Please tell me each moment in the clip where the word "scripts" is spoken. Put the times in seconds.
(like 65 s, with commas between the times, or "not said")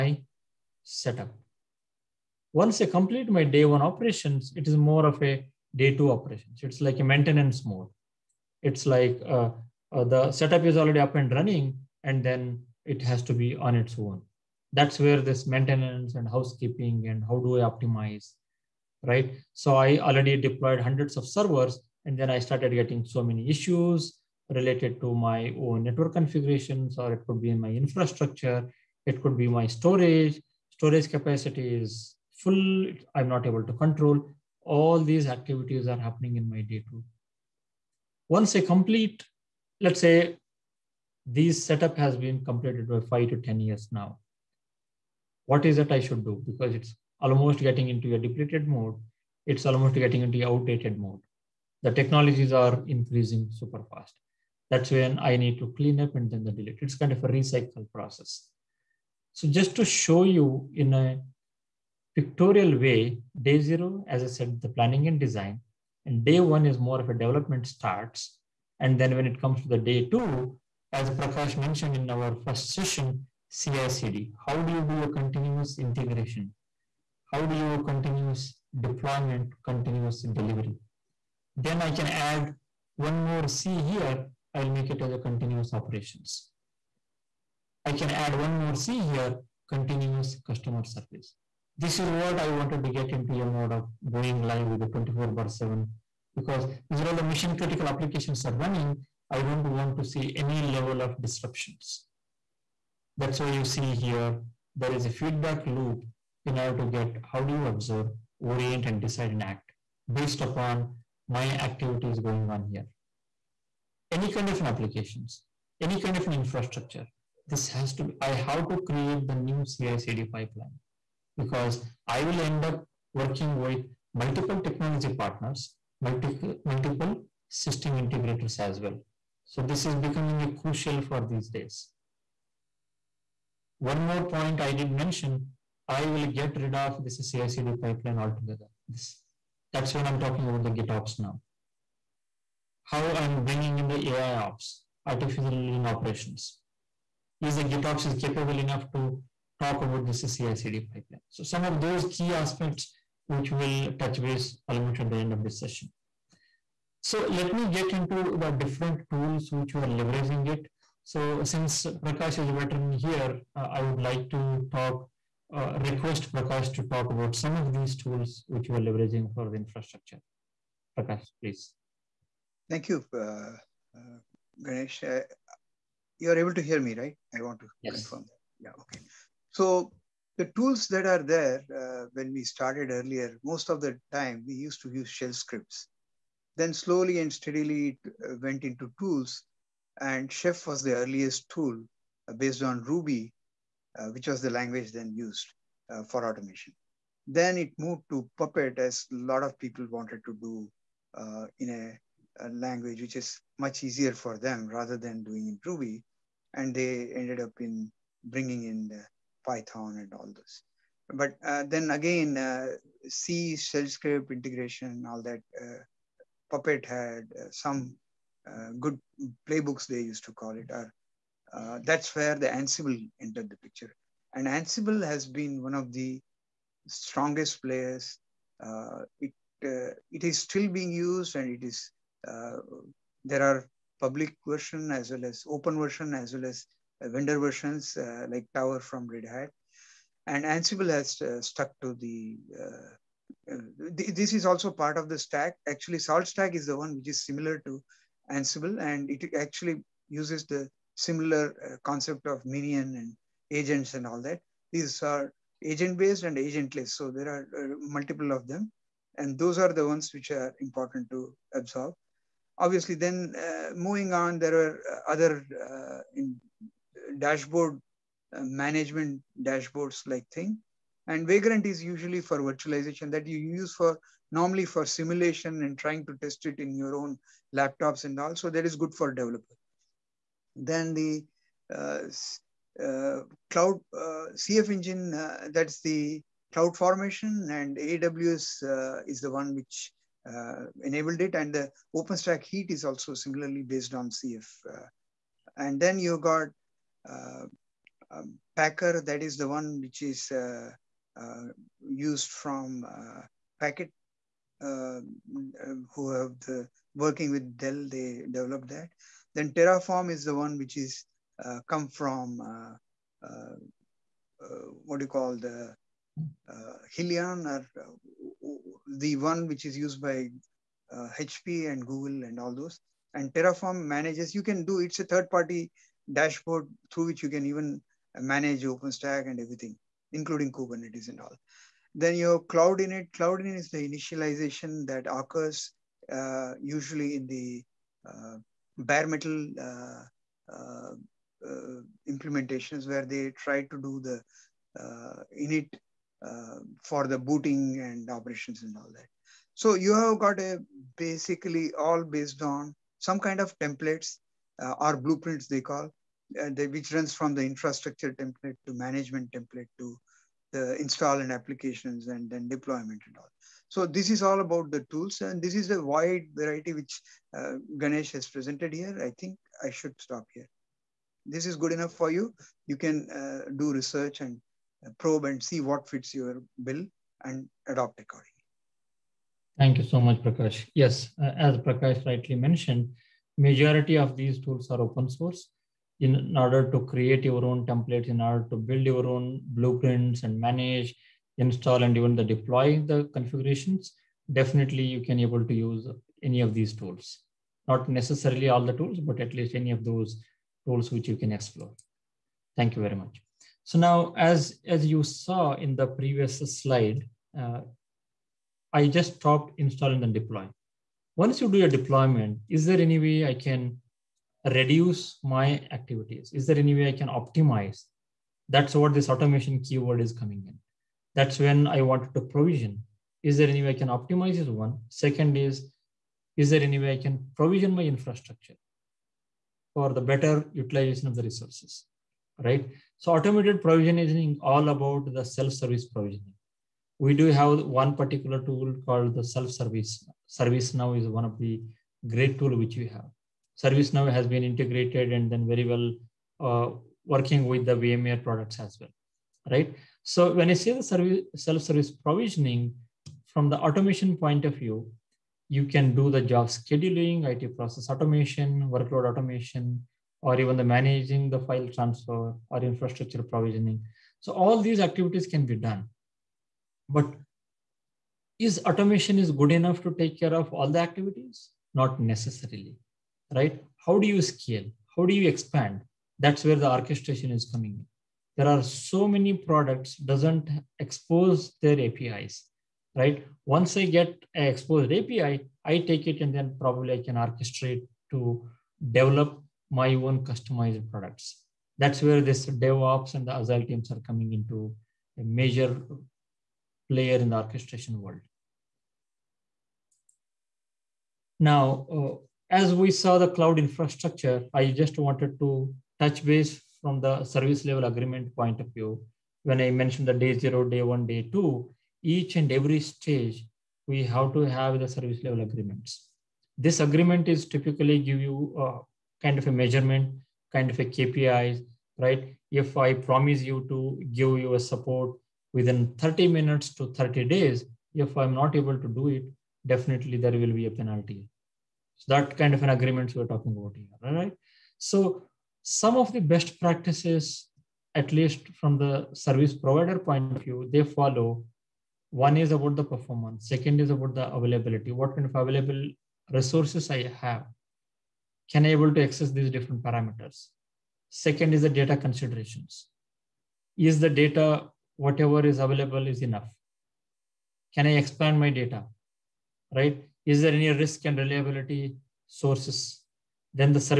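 185 s, 213 s.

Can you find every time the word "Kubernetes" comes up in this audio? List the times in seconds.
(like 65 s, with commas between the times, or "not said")
330 s.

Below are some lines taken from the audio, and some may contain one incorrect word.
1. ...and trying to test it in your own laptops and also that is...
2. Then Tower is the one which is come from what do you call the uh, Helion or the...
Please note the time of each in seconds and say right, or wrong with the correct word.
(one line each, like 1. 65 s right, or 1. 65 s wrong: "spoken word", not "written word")
1. 275 s right
2. 309 s wrong: "Terraform", not "Tower".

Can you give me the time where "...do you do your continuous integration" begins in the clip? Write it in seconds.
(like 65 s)
74 s.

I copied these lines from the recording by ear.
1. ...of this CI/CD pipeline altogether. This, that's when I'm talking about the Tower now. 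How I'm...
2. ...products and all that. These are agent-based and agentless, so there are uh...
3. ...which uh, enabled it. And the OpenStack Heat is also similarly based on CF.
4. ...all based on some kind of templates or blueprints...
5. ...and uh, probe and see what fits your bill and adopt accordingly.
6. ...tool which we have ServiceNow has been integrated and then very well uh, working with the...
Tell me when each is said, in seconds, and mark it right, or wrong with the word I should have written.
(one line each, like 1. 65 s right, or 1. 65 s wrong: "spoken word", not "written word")
1. 136 s wrong: "GitOps", not "Tower"
2. 253 s wrong: "agents", not "products"
3. 289 s right
4. 351 s right
5. 374 s right
6. 442 s right.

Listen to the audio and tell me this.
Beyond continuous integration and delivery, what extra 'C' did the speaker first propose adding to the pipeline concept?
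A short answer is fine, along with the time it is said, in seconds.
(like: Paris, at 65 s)
continuous operations, at 85 s.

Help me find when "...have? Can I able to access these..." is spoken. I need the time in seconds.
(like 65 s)
547 s.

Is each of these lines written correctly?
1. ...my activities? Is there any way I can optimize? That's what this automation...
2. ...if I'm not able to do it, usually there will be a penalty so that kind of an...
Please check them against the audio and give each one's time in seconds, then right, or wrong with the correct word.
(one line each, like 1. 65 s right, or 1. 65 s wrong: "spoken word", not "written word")
1. 415 s right
2. 527 s wrong: "definitely", not "usually".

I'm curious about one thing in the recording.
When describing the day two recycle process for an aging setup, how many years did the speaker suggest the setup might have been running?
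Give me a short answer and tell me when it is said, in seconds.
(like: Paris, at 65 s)
5 to 10 years, at 43 s.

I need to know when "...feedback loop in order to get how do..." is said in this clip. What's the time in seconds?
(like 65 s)
105 s.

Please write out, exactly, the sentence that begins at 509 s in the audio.
When I mentioned the day zero, day one, day two, each and every stage, we have to have the service level agreements.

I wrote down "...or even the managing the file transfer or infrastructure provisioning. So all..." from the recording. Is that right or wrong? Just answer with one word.
right.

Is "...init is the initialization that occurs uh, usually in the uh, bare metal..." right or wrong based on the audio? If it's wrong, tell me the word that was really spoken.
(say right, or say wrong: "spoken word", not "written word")
right.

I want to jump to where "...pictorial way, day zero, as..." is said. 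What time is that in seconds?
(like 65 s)
62 s.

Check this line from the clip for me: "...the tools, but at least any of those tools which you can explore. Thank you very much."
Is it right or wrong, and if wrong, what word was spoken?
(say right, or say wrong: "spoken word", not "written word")
right.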